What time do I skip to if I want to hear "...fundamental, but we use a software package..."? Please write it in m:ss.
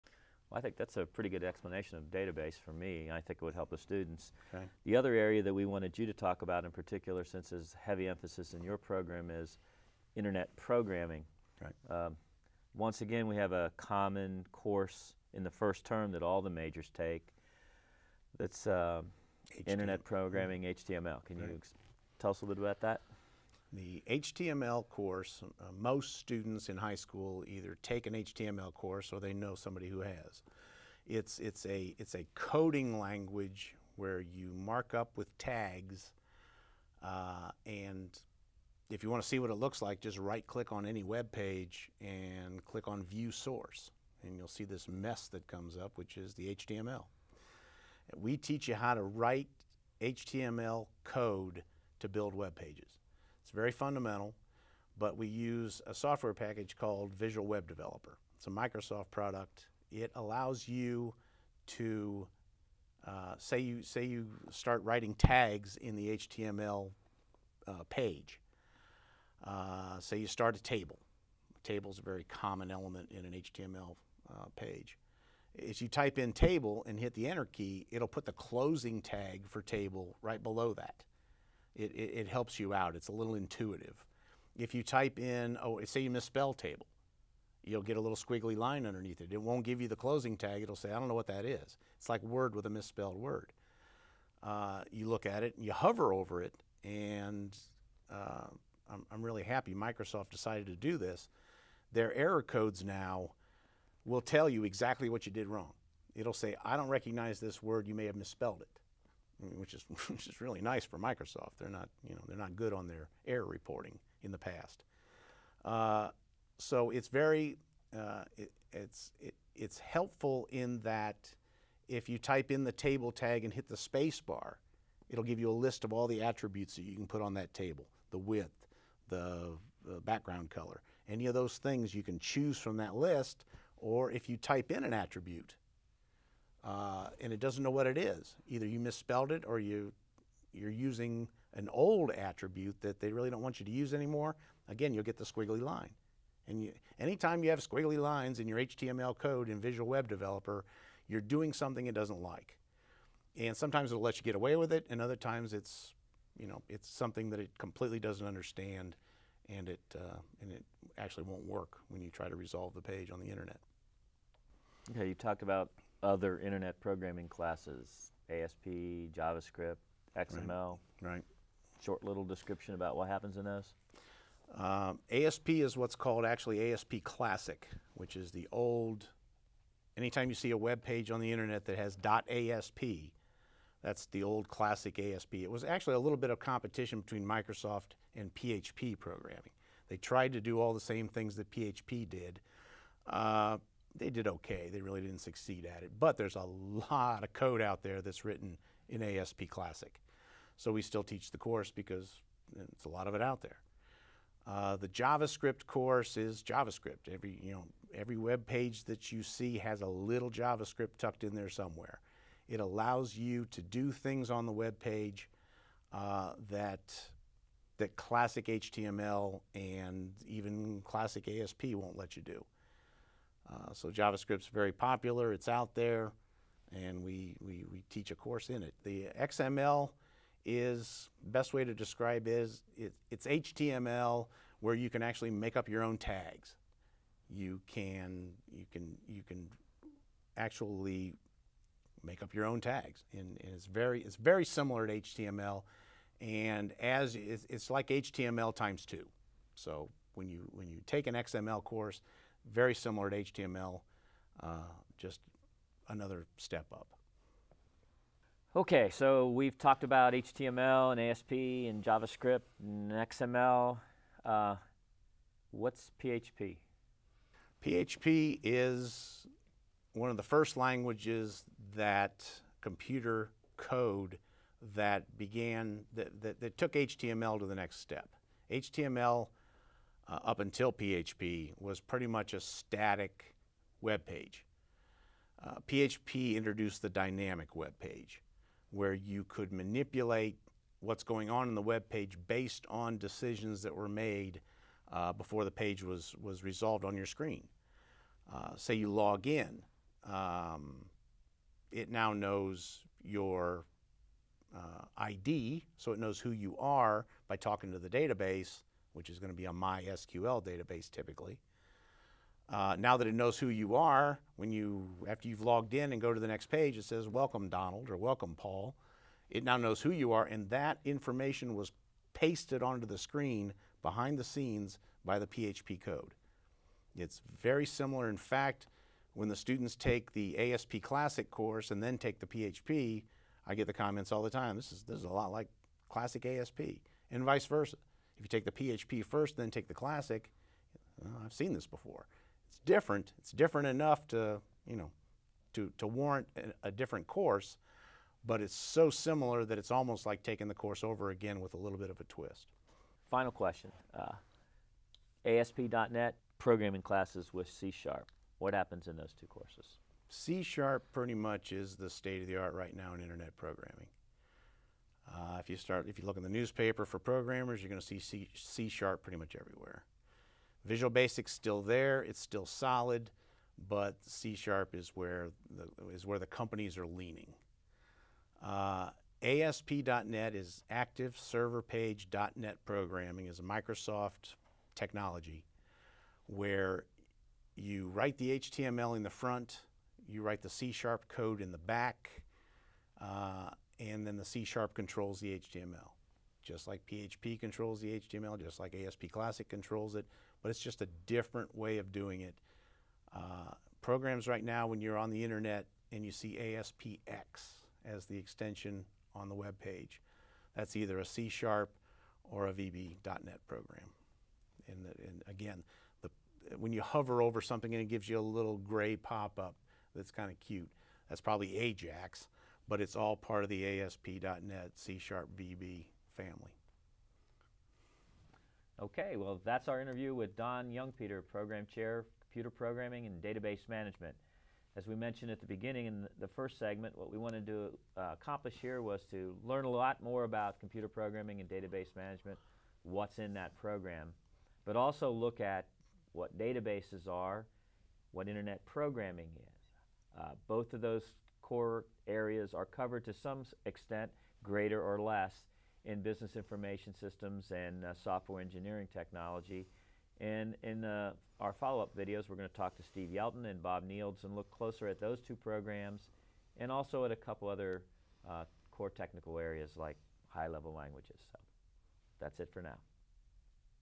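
0:53.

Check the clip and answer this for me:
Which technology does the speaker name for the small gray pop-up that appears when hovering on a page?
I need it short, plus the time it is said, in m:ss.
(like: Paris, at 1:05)
AJAX, at 7:01.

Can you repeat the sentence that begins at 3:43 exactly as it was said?
Uh, so JavaScript's very popular, it's out there, and we, we, we, teach a course in it.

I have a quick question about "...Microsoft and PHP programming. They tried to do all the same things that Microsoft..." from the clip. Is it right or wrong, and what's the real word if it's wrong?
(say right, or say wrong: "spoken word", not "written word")
wrong: "PHP", not "Microsoft".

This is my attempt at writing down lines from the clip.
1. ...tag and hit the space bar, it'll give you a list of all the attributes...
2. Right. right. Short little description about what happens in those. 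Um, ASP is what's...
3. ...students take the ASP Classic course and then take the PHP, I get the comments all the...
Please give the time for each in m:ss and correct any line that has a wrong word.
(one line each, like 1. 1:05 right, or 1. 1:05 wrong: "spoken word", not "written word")
1. 2:03 right
2. 2:51 right
3. 5:29 right.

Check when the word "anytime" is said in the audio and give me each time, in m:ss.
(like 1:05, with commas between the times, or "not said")
2:26, 2:59.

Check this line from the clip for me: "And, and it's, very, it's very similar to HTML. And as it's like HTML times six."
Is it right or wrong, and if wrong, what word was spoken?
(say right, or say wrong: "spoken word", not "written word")
wrong: "two", not "six".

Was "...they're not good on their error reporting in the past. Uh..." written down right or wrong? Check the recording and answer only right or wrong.
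right.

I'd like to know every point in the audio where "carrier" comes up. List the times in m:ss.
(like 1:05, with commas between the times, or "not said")
not said.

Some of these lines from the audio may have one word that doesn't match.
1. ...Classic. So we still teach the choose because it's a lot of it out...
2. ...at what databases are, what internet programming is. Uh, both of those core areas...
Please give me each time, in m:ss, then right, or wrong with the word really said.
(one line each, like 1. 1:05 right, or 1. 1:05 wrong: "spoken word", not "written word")
1. 3:19 wrong: "course", not "choose"
2. 7:25 right.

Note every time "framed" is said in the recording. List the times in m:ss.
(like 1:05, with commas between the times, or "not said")
not said.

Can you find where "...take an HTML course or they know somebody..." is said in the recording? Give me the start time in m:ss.
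0:27.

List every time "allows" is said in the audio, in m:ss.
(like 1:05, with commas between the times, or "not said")
1:00, 3:32.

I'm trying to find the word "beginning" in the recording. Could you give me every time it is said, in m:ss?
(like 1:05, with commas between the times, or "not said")
7:15.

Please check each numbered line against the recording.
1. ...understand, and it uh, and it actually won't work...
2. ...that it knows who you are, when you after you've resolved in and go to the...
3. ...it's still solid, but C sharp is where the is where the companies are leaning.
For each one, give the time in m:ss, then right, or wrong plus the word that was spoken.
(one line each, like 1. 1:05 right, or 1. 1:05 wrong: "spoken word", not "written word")
1. 2:38 right
2. 5:12 wrong: "logged", not "resolved"
3. 6:12 right.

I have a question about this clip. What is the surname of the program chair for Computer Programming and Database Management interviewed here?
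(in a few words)
Youngpeter.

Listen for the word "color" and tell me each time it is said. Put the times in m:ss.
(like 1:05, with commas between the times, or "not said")
2:10.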